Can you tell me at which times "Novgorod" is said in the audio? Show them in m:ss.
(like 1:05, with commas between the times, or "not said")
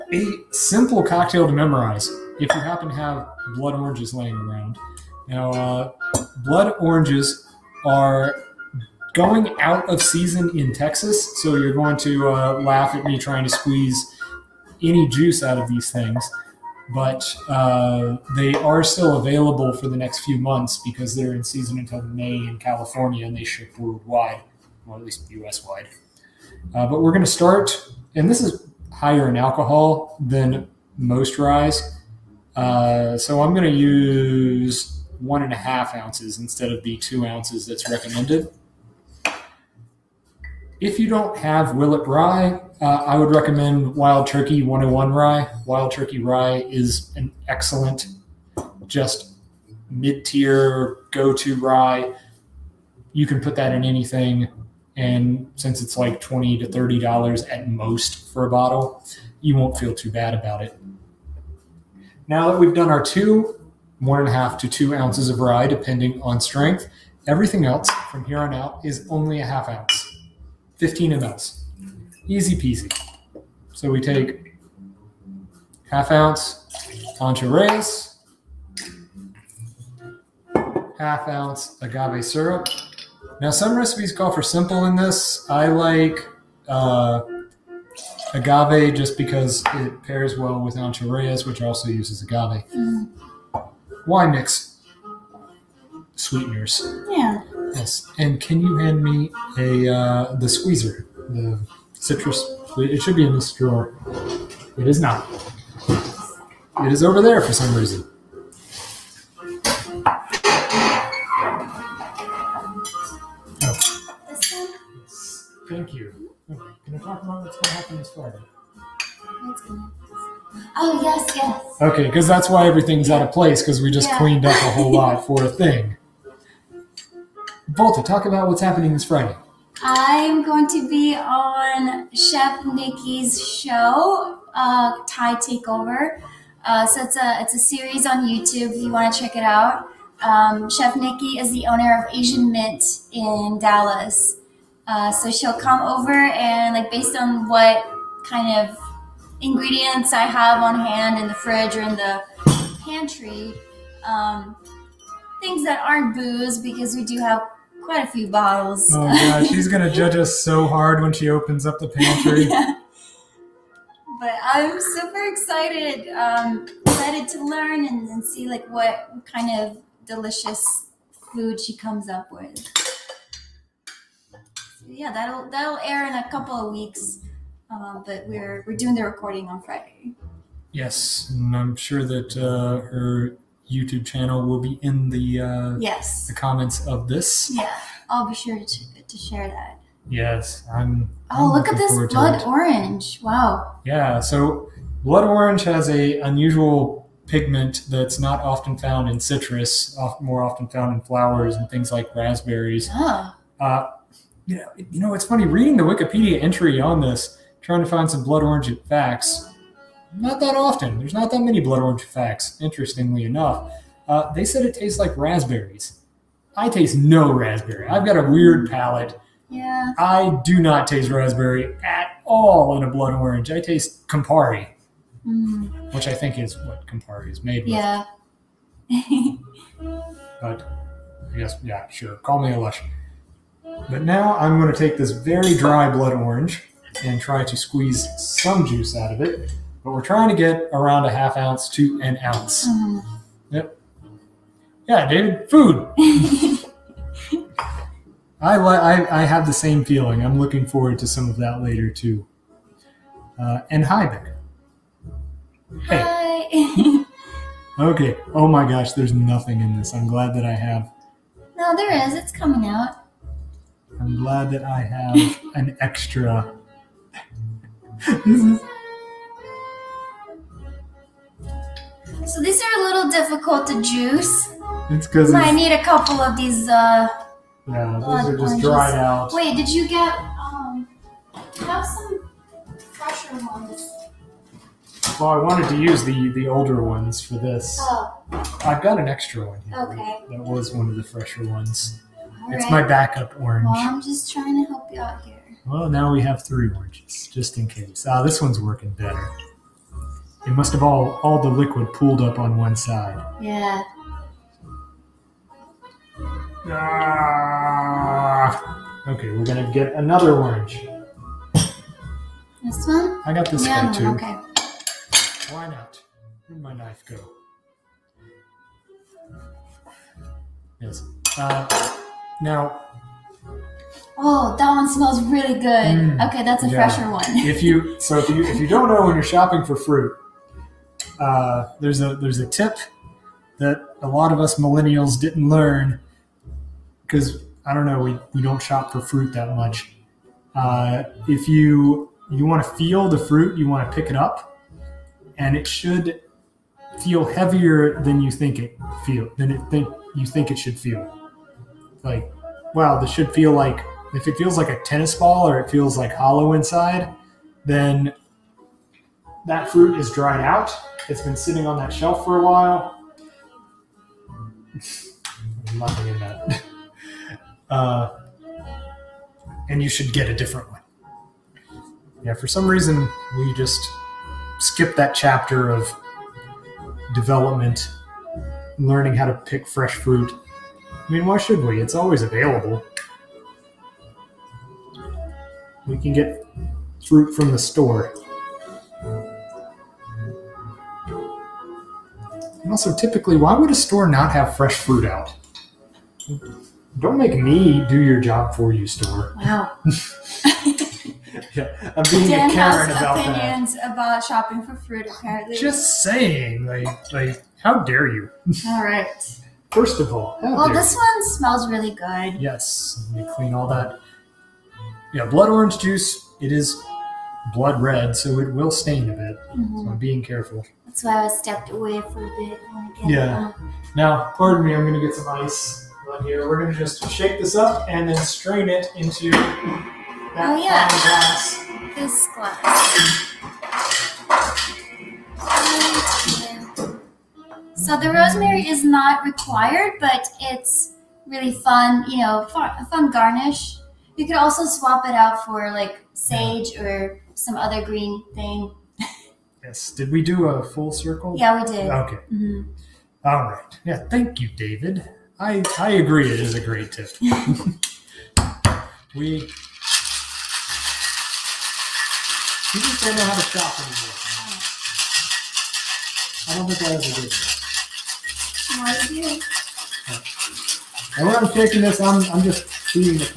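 not said.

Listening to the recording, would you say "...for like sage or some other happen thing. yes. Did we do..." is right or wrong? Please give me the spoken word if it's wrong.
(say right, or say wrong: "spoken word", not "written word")
wrong: "green", not "happen".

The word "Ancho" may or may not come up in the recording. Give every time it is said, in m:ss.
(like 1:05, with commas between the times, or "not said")
1:17, 1:30.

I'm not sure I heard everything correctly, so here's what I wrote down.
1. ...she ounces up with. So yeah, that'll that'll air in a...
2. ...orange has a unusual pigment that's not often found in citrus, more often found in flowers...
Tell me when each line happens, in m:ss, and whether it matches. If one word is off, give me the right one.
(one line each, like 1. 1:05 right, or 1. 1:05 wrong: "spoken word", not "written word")
1. 2:51 wrong: "comes", not "ounces"
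2. 3:15 right.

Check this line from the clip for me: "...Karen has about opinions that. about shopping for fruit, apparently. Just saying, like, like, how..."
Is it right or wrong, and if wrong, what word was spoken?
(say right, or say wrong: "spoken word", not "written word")
right.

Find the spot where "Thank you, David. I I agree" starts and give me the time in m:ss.
7:34.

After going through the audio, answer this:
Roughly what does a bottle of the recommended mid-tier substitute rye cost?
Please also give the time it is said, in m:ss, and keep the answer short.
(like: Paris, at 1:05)
$20 to $30, at 0:56.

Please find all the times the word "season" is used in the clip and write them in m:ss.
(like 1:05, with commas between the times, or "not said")
0:10, 0:21.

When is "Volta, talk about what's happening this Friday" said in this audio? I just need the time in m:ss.
2:07.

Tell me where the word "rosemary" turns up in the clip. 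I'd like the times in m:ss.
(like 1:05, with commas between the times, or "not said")
7:18.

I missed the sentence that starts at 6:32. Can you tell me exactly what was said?
And also, typically, why would a store not have fresh fruit out?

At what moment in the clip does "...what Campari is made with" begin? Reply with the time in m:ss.
3:46.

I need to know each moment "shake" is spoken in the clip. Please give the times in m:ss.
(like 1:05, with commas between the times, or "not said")
7:07.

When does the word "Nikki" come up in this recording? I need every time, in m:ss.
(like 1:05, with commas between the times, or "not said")
2:12, 2:20.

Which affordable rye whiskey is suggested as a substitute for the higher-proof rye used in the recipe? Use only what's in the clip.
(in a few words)
Wild Turkey 101.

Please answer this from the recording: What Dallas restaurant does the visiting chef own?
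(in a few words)
Asian Mint.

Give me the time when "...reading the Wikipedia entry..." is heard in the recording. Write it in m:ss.
3:25.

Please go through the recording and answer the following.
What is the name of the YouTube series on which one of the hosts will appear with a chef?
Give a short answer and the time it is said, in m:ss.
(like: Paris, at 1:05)
Thai Takeover, at 2:15.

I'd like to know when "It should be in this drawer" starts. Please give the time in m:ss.
1:42.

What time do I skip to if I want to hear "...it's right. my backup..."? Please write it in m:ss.
4:52.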